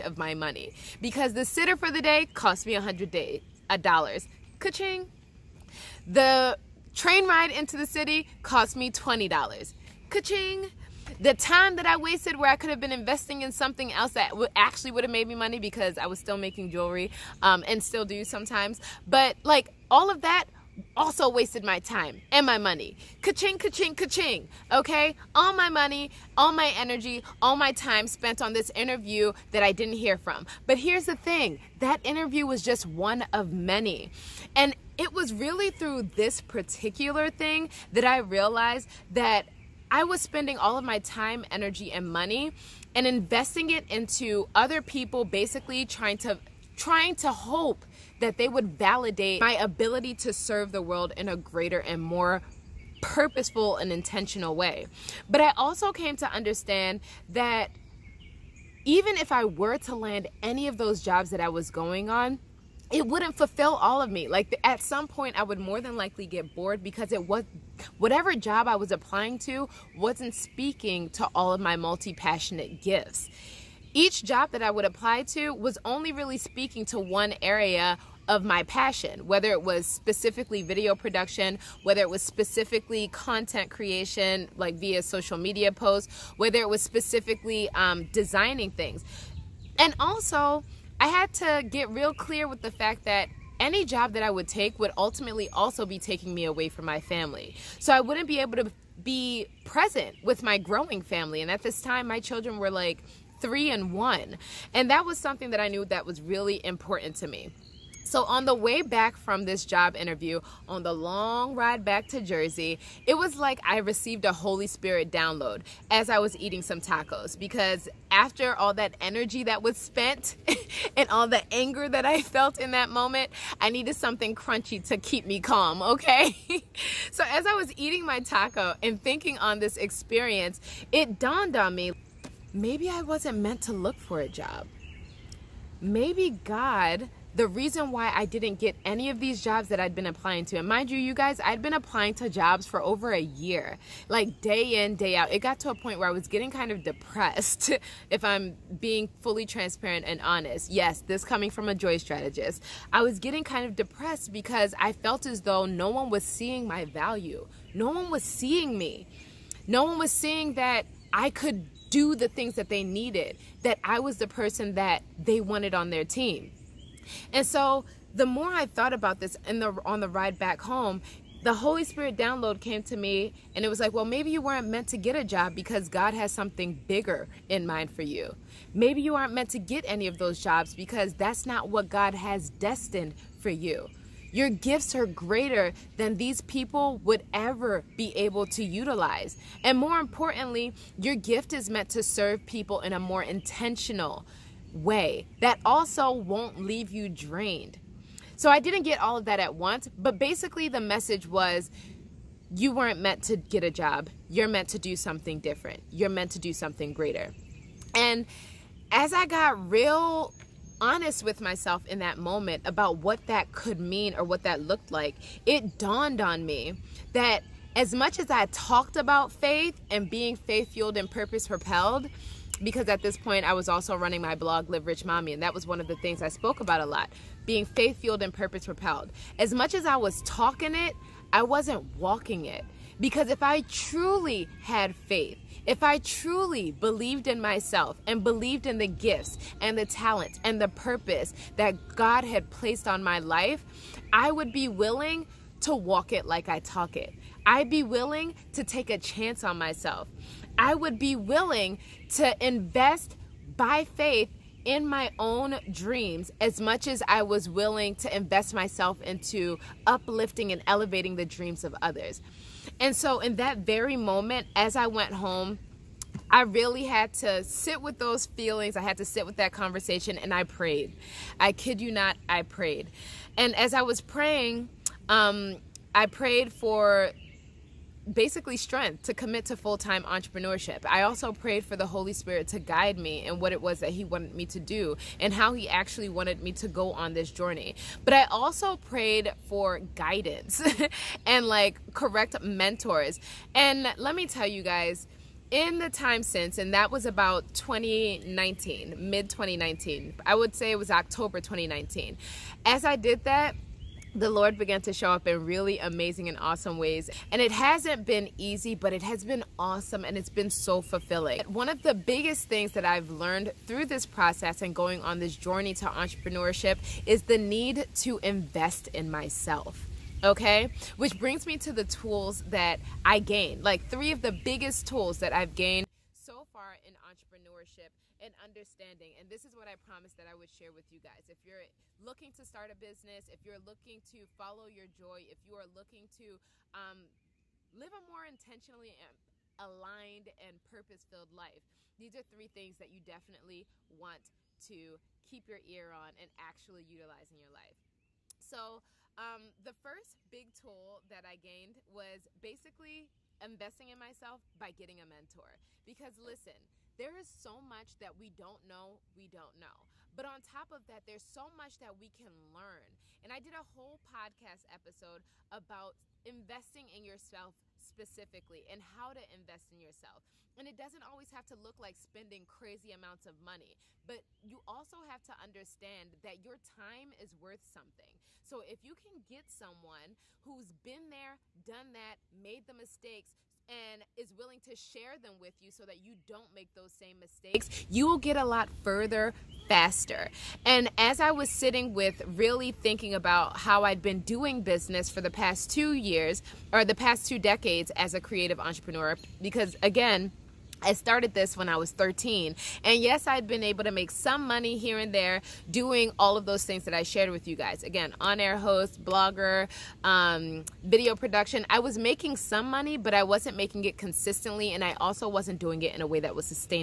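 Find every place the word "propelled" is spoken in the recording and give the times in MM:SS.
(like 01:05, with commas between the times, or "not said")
03:41, 03:48.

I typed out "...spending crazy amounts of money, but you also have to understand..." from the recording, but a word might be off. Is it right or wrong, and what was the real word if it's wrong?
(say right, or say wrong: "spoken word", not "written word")
right.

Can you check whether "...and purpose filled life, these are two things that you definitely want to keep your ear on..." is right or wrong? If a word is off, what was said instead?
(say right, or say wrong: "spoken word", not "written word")
wrong: "three", not "two".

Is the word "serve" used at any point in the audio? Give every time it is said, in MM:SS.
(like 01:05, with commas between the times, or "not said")
00:50, 03:12.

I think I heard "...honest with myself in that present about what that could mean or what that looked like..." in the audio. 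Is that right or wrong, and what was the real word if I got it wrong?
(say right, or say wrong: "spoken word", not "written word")
wrong: "moment", not "present".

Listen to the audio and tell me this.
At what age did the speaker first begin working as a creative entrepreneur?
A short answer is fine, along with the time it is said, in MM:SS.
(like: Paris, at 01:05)
13, at 06:41.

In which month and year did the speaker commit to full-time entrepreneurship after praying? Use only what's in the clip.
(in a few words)
October 2019.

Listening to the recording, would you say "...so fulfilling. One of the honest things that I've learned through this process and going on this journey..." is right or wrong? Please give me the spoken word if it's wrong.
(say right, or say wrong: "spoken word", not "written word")
wrong: "biggest", not "honest".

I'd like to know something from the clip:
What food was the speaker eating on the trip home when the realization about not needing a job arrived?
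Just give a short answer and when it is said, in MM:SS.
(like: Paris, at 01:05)
Tacos, at 01:56.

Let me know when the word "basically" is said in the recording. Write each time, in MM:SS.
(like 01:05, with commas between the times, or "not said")
00:45, 03:20, 04:38, 05:52.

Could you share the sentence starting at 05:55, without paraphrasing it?
Because listen, there is so much that we don't know, we don't know.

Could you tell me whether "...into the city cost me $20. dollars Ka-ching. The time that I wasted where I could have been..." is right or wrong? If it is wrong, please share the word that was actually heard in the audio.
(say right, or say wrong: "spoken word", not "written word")
right.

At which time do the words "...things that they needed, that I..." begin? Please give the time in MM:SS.
02:42.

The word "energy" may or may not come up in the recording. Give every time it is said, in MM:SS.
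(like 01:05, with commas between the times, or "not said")
00:26, 00:41, 01:59.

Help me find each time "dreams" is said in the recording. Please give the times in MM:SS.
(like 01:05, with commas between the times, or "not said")
04:15, 04:21.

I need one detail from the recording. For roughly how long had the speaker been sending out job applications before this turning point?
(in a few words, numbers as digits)
Over a year.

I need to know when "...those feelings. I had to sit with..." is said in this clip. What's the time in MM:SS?
04:27.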